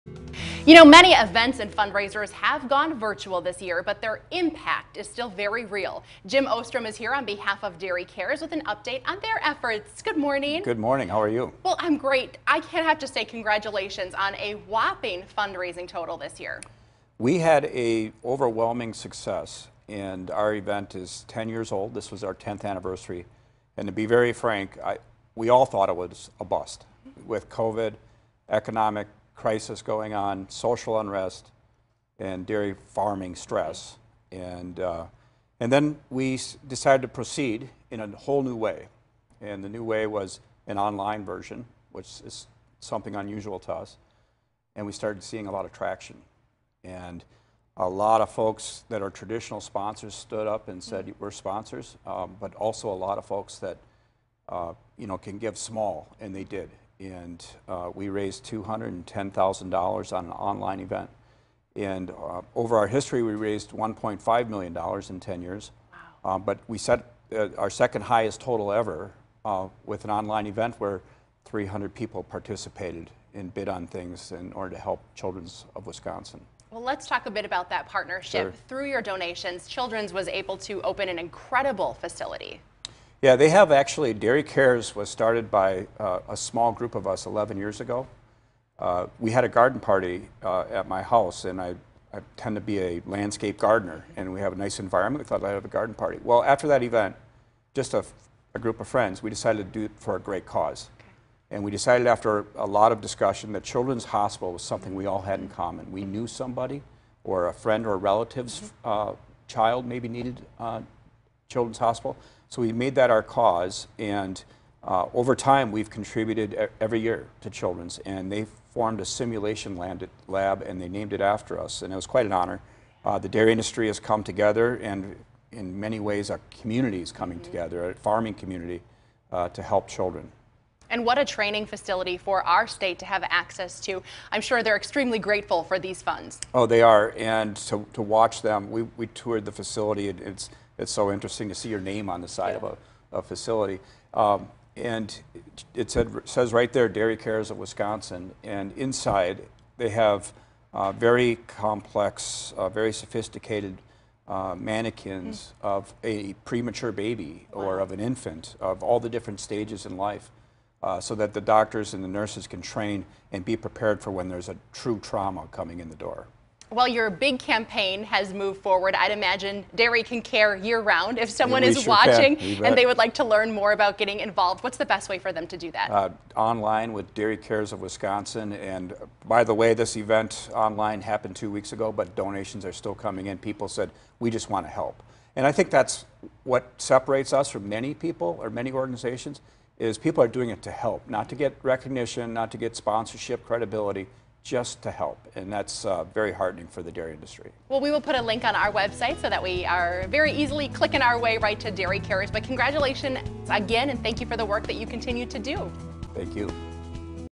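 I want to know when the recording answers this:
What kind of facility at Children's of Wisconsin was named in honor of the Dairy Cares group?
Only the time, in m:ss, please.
1:59.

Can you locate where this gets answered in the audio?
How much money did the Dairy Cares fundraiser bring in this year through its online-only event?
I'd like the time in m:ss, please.
0:58.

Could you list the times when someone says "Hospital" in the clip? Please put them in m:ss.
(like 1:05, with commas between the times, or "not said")
1:44, 1:51.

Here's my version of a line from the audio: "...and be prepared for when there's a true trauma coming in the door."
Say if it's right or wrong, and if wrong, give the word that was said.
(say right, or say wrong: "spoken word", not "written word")
right.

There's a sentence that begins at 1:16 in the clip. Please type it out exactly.
Well, let's talk a bit about that partnership.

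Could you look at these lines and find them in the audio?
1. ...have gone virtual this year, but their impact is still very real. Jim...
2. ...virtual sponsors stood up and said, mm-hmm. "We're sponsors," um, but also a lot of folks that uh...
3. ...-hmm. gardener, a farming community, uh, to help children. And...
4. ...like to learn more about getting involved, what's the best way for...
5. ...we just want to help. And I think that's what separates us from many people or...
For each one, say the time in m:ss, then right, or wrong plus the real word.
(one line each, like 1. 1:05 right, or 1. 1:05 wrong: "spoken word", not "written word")
1. 0:02 right
2. 0:49 wrong: "traditional", not "virtual"
3. 2:07 wrong: "together", not "gardener"
4. 2:52 right
5. 3:04 right.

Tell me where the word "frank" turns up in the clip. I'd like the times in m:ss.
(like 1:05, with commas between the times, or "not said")
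0:24.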